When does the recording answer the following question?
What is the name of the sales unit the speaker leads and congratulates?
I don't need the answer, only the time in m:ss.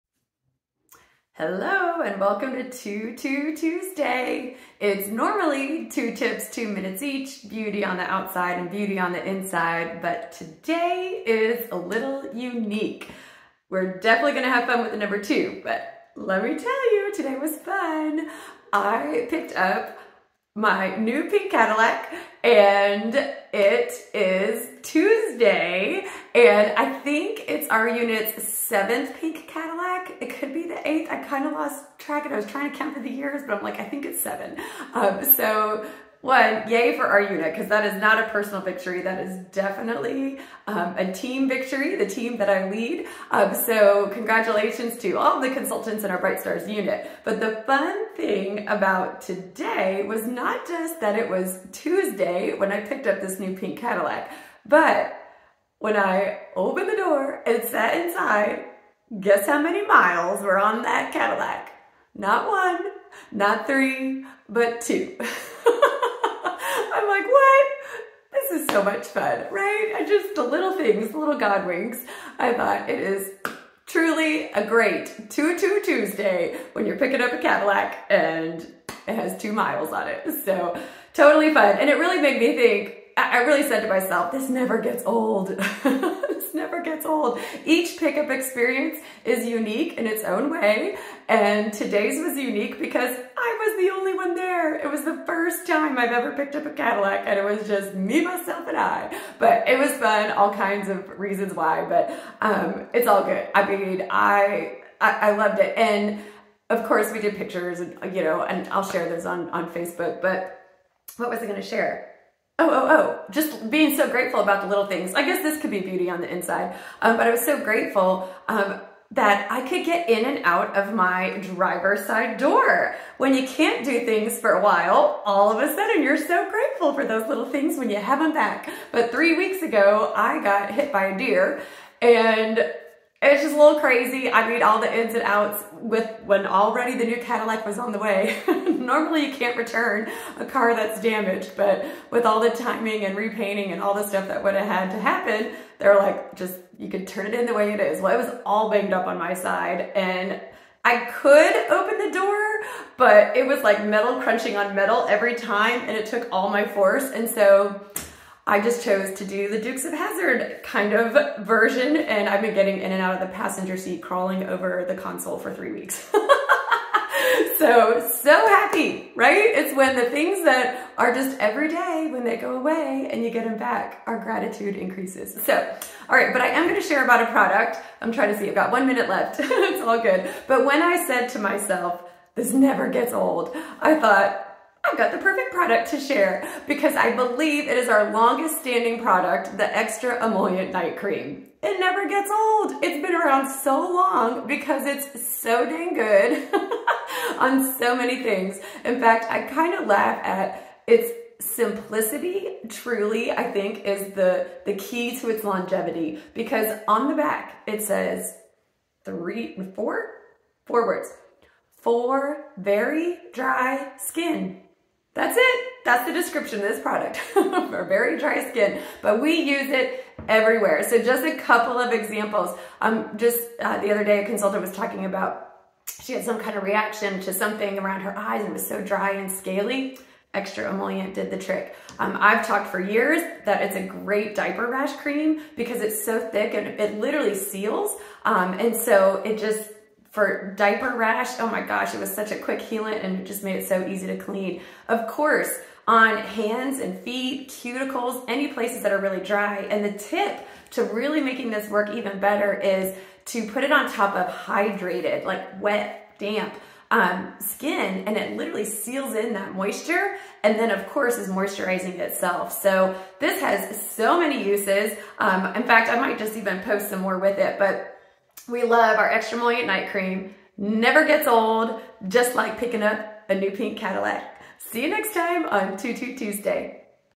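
0:46.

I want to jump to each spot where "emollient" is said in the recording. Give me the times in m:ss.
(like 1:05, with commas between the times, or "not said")
3:10, 3:50, 4:29.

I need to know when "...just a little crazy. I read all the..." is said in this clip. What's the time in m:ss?
2:13.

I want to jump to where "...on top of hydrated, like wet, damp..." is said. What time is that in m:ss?
4:13.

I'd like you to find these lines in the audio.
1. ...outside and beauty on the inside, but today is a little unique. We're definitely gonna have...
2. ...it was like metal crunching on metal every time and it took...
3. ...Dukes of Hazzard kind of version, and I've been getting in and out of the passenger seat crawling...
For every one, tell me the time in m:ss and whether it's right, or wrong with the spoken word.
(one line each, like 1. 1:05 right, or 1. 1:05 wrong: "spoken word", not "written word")
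1. 0:08 right
2. 2:33 right
3. 2:39 right.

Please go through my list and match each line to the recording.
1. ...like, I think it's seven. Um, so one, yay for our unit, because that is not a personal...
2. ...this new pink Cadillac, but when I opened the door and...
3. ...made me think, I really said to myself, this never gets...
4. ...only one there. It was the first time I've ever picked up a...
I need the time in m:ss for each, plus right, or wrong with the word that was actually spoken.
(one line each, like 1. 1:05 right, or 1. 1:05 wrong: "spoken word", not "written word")
1. 0:33 right
2. 0:53 right
3. 1:22 right
4. 1:33 right.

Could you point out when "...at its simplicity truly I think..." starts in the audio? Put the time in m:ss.
3:20.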